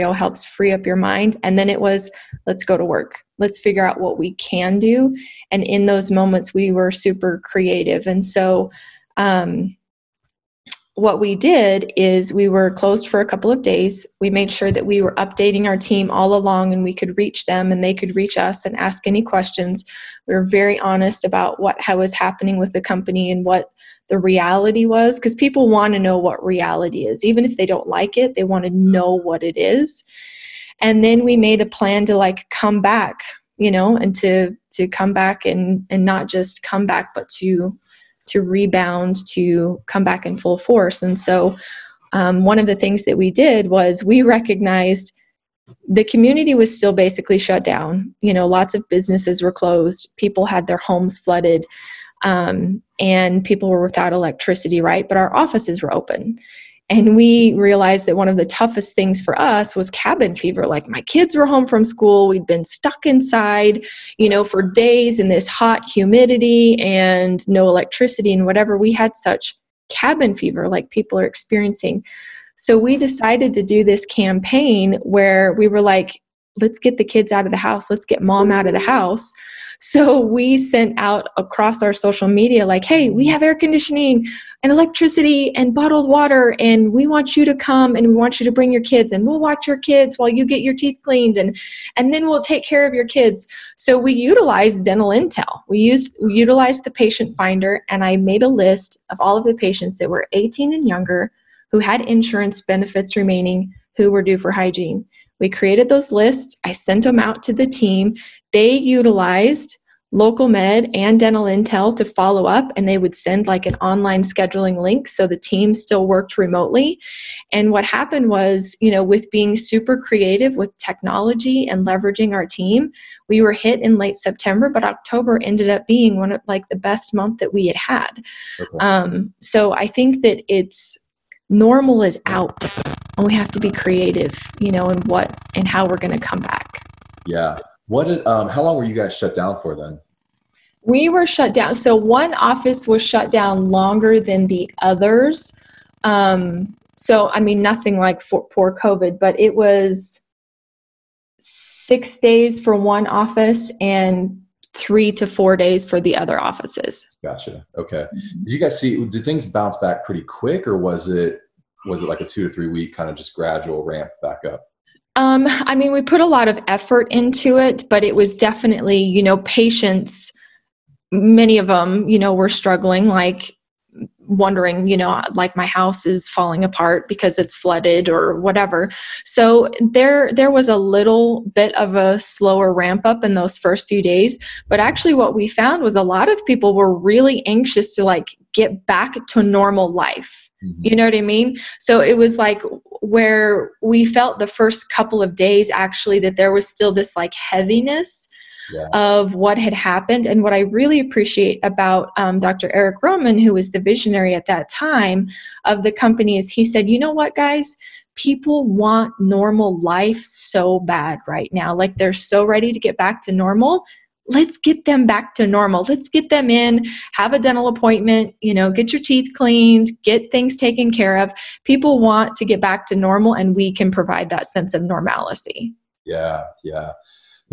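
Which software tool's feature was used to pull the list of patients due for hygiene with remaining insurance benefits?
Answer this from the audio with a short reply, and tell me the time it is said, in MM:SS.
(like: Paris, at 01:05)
patient finder, at 01:36.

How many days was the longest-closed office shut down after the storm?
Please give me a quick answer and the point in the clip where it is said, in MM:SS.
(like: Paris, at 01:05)
6, at 02:31.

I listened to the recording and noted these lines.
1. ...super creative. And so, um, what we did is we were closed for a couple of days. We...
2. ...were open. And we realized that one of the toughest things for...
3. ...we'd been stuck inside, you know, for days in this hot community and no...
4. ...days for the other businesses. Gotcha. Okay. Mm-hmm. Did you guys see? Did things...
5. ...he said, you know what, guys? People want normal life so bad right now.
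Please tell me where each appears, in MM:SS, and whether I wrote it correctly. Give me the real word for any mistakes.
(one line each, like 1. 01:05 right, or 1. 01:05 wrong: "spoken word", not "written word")
1. 00:06 right
2. 00:55 right
3. 01:02 wrong: "humidity", not "community"
4. 02:35 wrong: "offices", not "businesses"
5. 03:26 right.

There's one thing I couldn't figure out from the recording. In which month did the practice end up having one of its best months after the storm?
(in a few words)
October.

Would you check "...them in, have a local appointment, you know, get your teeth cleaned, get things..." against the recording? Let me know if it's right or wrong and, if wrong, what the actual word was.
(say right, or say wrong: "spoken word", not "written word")
wrong: "dental", not "local".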